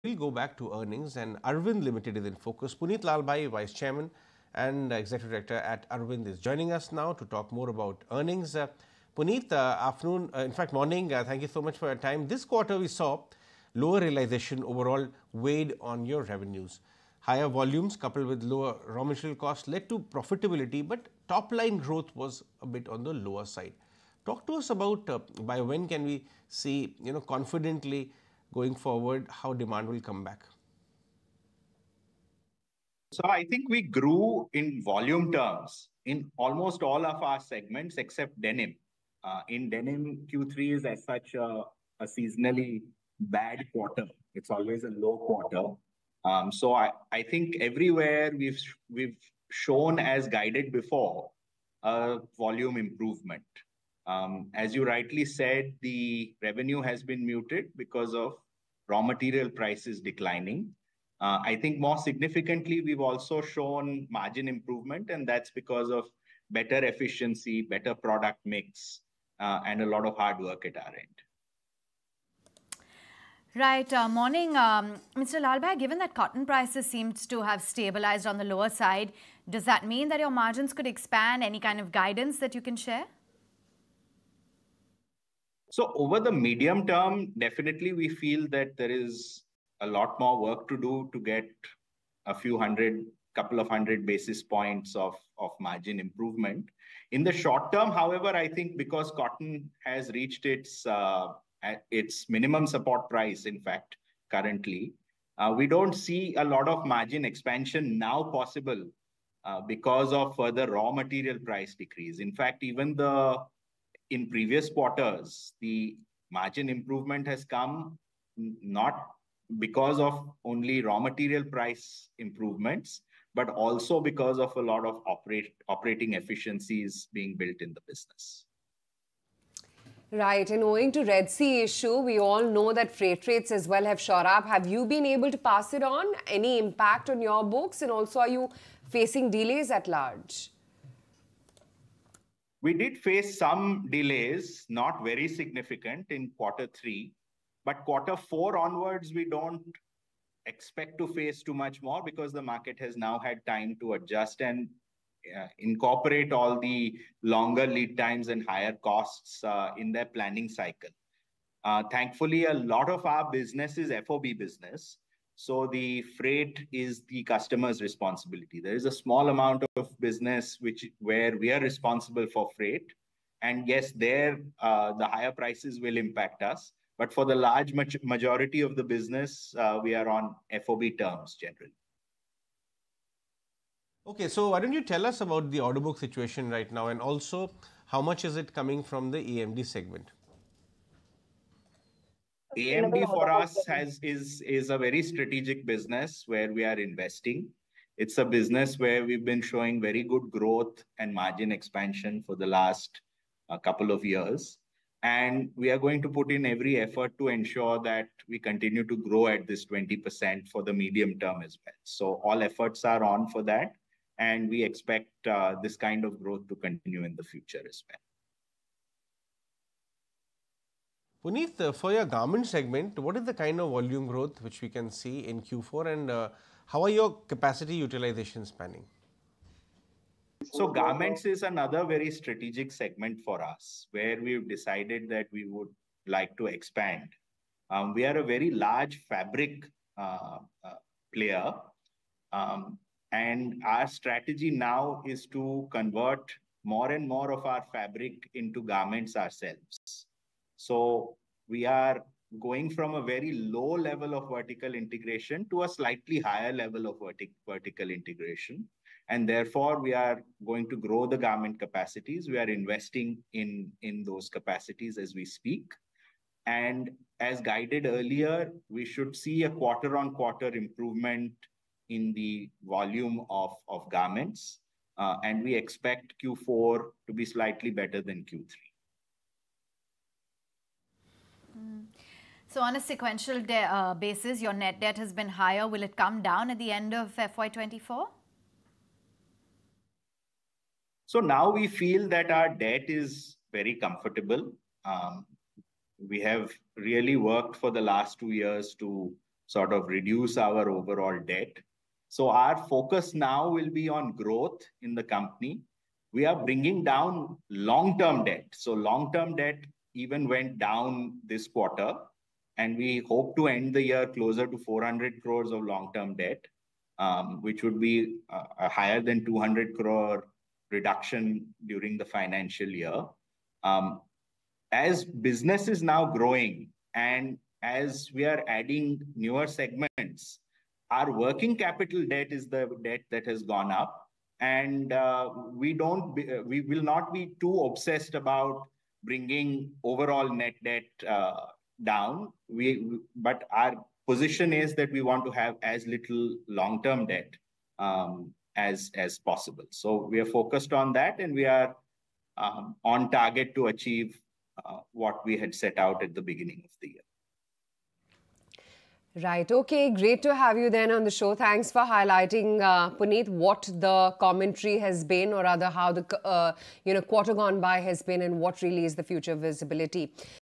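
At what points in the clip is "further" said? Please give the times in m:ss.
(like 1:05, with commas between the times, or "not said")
1:50.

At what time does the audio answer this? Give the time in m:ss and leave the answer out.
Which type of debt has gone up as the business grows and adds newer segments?
5:31.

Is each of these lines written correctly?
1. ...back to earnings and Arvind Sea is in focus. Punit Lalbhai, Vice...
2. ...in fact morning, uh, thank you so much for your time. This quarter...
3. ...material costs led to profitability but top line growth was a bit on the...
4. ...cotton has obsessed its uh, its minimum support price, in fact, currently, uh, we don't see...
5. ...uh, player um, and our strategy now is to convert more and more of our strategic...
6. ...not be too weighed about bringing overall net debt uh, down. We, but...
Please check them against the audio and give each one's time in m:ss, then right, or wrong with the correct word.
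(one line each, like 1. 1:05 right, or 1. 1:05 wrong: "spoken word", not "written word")
1. 0:00 wrong: "Limited", not "Sea"
2. 0:10 right
3. 0:19 right
4. 1:39 wrong: "reached", not "obsessed"
5. 4:00 wrong: "fabric", not "strategic"
6. 5:36 wrong: "obsessed", not "weighed".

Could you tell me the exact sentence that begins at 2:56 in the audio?
But for the large majority of the business, uh, we are on FOB terms generally.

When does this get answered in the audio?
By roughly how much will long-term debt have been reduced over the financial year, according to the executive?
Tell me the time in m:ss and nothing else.
5:19.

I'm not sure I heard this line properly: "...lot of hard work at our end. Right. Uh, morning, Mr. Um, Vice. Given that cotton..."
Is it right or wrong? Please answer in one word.
wrong.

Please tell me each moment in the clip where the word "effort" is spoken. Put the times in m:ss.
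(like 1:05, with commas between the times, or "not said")
3:26, 3:32.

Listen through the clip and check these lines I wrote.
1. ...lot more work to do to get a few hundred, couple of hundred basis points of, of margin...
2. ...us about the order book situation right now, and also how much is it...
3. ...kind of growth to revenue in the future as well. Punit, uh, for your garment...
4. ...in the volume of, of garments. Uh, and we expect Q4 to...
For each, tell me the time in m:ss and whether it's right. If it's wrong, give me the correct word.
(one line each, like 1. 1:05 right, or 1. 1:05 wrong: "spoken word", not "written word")
1. 1:29 right
2. 3:05 right
3. 3:35 wrong: "continue", not "revenue"
4. 4:31 right.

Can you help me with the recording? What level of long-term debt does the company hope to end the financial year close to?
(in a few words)
400 crores.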